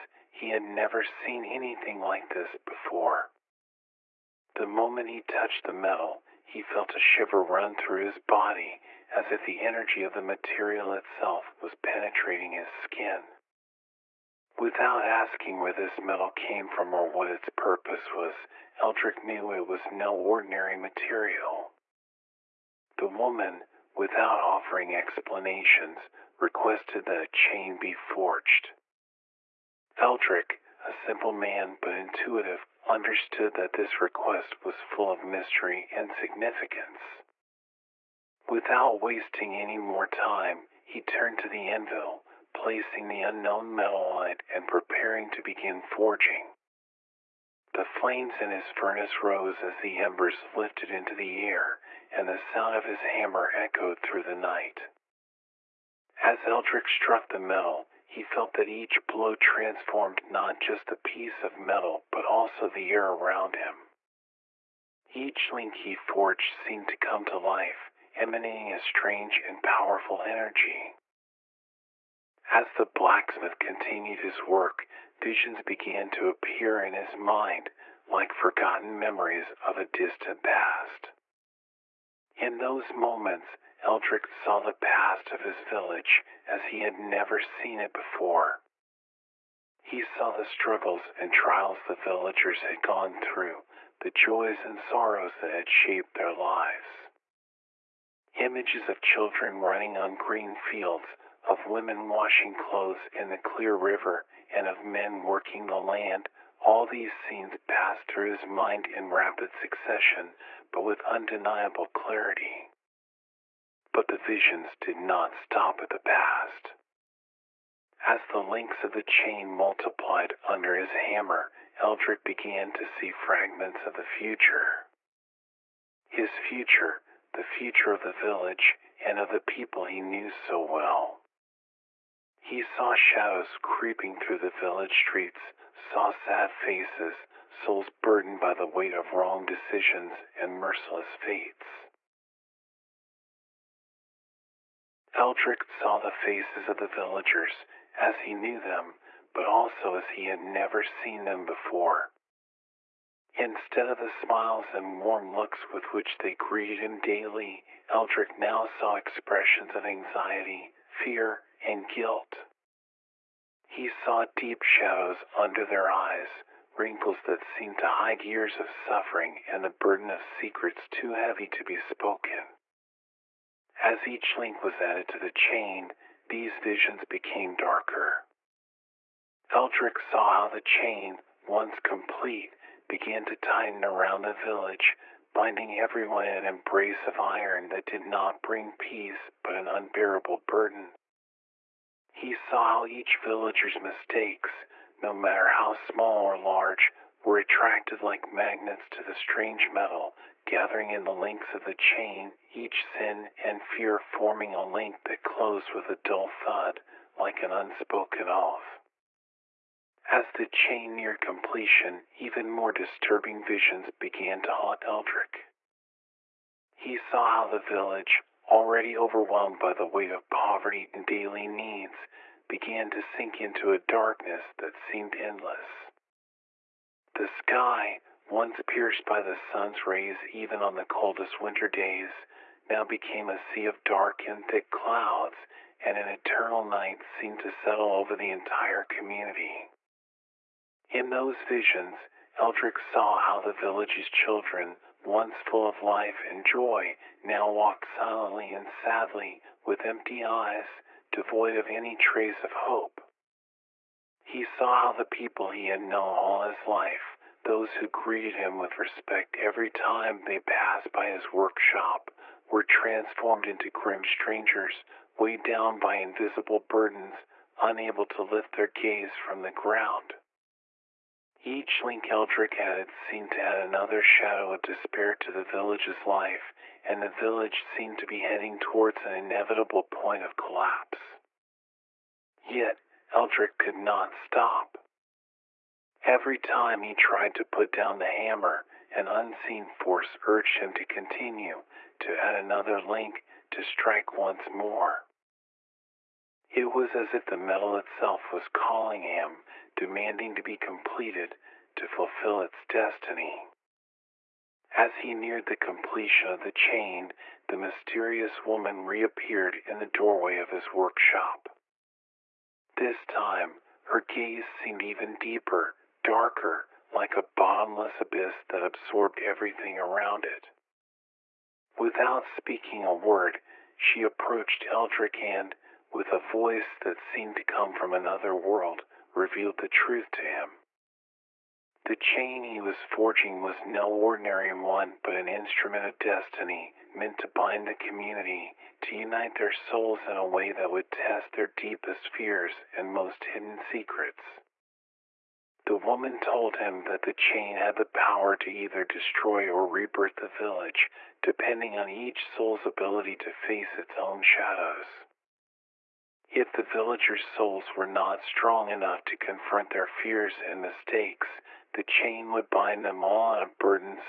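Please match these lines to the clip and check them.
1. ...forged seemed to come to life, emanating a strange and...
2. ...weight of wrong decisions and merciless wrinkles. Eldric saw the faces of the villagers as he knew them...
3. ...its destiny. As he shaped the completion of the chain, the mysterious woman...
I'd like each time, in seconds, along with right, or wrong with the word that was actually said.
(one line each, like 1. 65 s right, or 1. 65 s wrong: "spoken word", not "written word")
1. 65 s right
2. 138 s wrong: "fates", not "wrinkles"
3. 302 s wrong: "neared", not "shaped".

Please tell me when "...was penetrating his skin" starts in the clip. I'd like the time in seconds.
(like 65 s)
11 s.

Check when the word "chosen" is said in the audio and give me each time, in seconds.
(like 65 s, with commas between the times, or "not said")
not said.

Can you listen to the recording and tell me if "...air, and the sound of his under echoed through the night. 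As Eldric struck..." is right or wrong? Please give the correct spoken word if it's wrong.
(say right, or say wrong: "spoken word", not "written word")
wrong: "hammer", not "under".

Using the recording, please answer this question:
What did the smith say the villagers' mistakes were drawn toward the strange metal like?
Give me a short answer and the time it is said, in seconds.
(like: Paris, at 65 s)
Magnets, at 198 s.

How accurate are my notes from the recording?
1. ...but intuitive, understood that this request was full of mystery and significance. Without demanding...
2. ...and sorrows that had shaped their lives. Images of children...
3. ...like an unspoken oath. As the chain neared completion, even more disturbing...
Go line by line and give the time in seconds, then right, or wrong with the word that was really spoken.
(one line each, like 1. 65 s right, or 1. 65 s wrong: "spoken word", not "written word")
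1. 31 s wrong: "wasting", not "demanding"
2. 94 s right
3. 207 s right.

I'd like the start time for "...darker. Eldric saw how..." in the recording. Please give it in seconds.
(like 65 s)
177 s.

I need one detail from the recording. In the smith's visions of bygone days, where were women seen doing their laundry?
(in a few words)
In the clear river.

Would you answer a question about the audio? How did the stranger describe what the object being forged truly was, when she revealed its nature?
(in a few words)
An instrument of destiny.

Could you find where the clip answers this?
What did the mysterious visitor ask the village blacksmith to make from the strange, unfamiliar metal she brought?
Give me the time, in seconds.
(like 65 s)
27 s.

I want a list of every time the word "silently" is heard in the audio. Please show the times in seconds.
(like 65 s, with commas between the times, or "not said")
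247 s.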